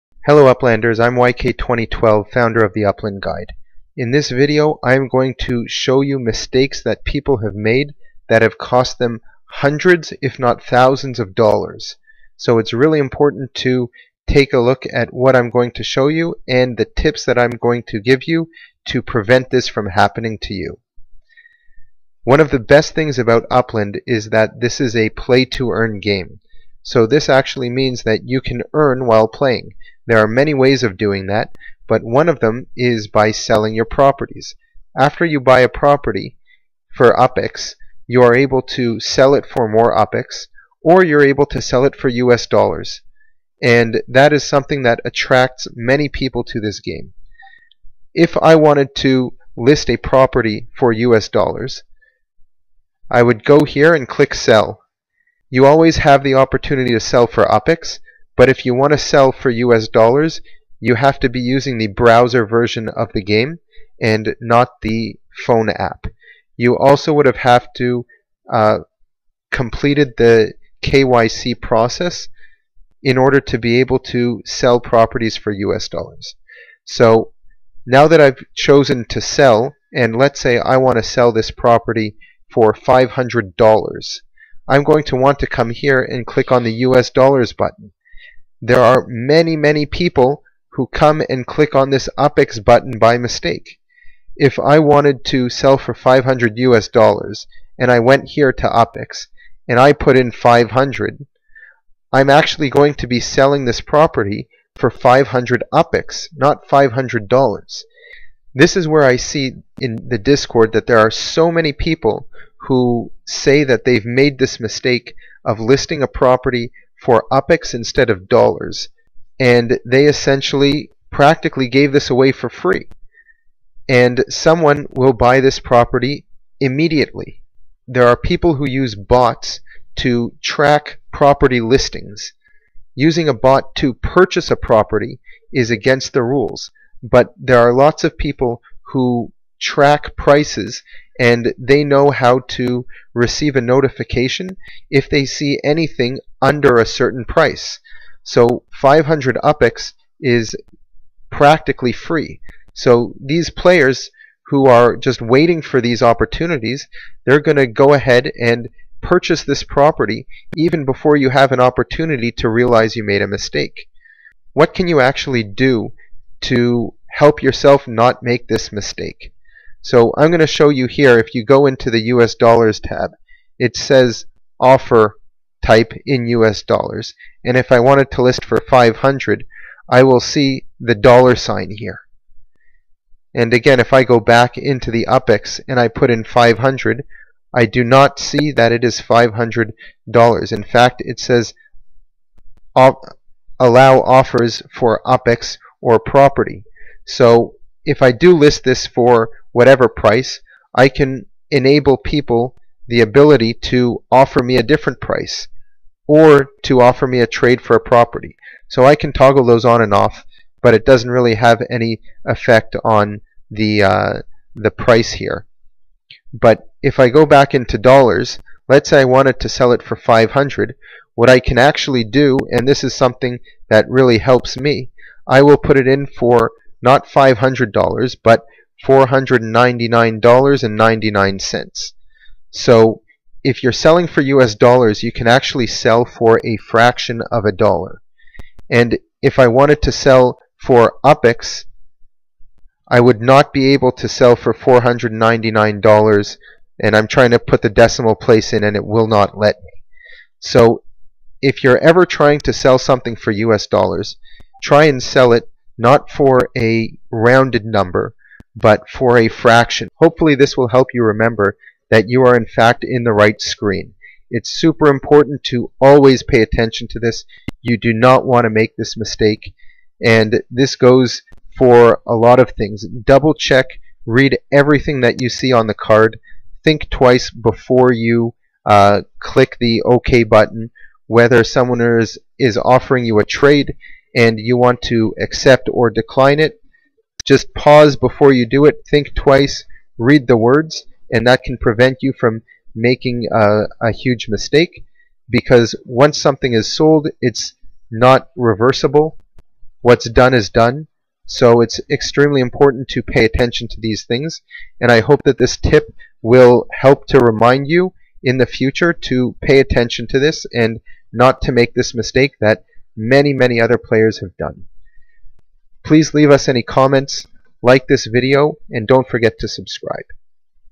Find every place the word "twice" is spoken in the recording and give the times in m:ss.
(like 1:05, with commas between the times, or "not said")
4:36, 4:49.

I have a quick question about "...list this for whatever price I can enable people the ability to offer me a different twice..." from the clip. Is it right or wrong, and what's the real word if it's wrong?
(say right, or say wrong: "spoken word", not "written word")
wrong: "price", not "twice".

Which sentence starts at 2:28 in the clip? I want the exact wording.
So 500 UPEX is practically free.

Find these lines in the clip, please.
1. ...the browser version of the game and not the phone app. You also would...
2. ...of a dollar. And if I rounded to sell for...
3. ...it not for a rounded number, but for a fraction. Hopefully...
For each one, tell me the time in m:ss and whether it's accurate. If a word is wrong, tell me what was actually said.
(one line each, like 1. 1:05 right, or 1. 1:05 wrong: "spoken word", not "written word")
1. 1:01 right
2. 3:57 wrong: "wanted", not "rounded"
3. 4:15 right.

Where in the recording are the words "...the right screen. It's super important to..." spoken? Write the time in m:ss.
4:23.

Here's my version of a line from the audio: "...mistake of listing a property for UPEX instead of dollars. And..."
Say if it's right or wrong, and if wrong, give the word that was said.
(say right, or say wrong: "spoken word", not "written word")
right.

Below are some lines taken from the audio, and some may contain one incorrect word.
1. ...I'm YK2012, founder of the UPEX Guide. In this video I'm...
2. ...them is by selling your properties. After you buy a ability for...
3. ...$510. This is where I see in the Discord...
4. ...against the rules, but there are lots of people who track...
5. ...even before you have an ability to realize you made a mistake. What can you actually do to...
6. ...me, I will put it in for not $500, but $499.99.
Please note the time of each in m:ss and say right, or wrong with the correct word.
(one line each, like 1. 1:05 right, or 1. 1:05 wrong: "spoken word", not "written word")
1. 0:00 wrong: "Upland", not "UPEX"
2. 0:32 wrong: "property", not "ability"
3. 1:46 wrong: "500", not "510"
4. 2:15 right
5. 2:40 wrong: "opportunity", not "ability"
6. 3:44 right.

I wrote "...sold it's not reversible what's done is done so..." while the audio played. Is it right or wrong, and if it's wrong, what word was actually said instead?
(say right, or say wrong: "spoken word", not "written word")
right.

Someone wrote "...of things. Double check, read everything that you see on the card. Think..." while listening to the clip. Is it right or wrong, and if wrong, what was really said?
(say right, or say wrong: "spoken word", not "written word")
right.